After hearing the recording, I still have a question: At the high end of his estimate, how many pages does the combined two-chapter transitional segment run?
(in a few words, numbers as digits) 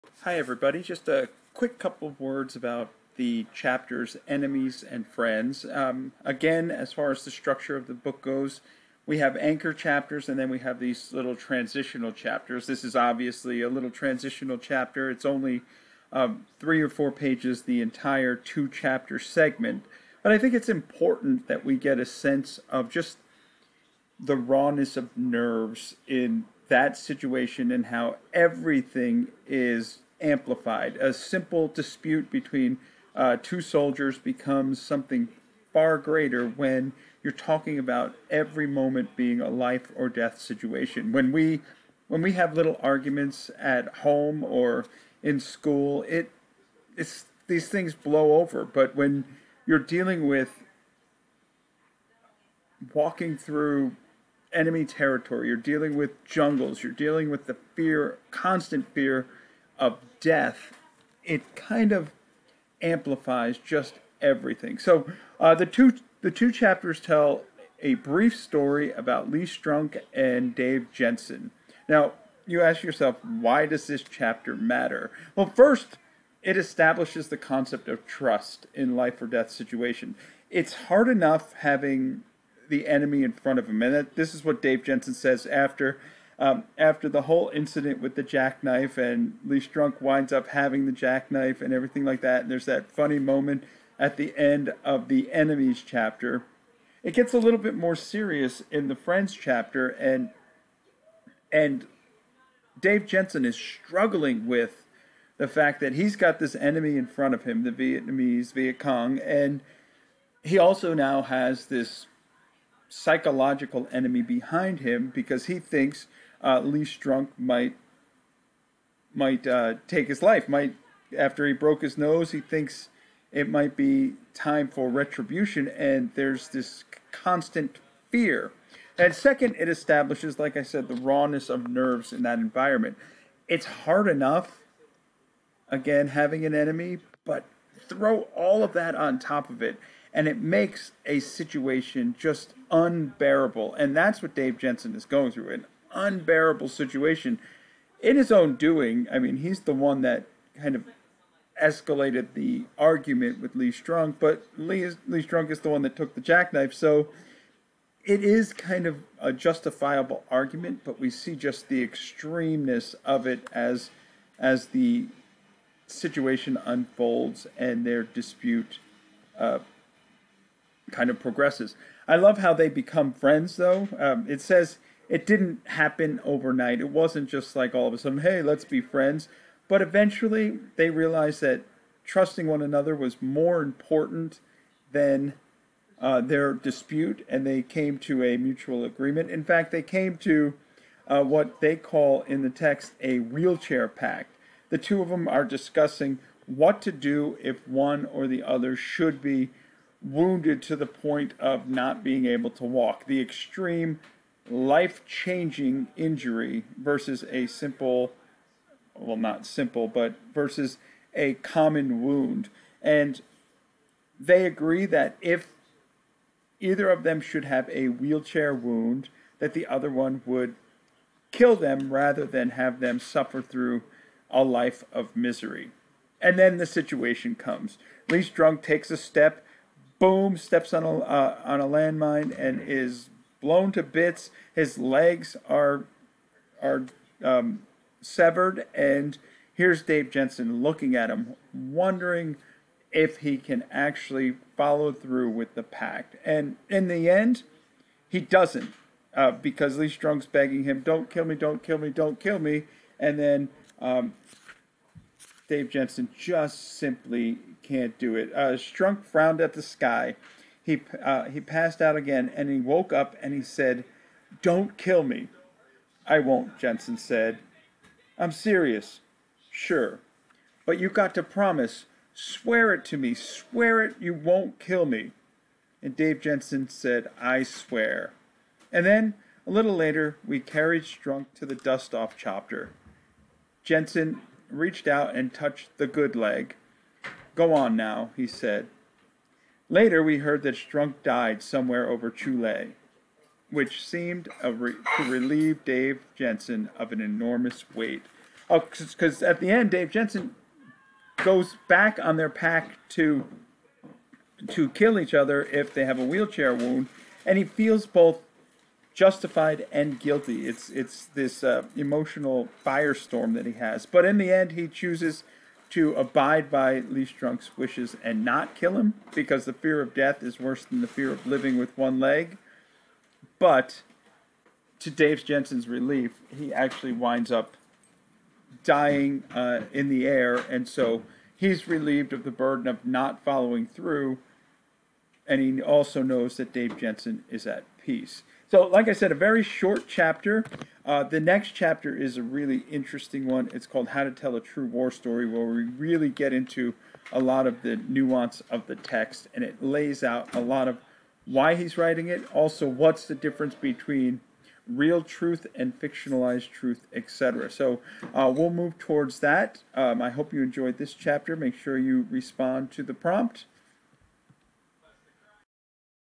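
4.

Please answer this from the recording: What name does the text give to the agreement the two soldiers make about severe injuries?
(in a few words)
wheelchair pact.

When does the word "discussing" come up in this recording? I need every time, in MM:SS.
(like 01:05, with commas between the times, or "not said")
03:15.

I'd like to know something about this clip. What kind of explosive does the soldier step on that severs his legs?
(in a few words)
landmine.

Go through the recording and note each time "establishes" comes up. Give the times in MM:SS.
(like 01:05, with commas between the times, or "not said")
01:16, 02:09.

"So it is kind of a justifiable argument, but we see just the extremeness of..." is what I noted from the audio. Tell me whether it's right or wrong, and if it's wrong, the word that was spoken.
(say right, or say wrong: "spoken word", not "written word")
right.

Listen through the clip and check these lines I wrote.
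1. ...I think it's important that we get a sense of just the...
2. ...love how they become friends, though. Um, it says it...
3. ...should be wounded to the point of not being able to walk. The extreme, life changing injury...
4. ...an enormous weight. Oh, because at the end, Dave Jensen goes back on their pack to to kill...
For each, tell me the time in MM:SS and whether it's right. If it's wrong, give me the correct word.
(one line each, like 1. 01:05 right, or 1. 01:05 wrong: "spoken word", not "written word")
1. 00:20 right
2. 02:52 right
3. 03:18 right
4. 04:56 right.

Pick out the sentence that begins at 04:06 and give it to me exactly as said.
And in the end, he doesn't uh, because Lee Strunk's begging him, don't kill me, don't kill me, don't kill me.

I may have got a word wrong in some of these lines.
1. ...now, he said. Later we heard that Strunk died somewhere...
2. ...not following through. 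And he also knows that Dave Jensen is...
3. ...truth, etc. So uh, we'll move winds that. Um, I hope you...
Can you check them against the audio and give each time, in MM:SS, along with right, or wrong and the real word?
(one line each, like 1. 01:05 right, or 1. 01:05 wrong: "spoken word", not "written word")
1. 04:47 right
2. 05:32 right
3. 05:56 wrong: "towards", not "winds".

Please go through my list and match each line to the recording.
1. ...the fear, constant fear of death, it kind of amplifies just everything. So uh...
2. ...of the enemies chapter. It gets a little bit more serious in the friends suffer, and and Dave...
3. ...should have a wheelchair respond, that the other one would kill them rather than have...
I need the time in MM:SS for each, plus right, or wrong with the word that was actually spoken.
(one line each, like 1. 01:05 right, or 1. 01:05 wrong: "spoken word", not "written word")
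1. 00:57 right
2. 01:34 wrong: "chapter", not "suffer"
3. 03:37 wrong: "wound", not "respond".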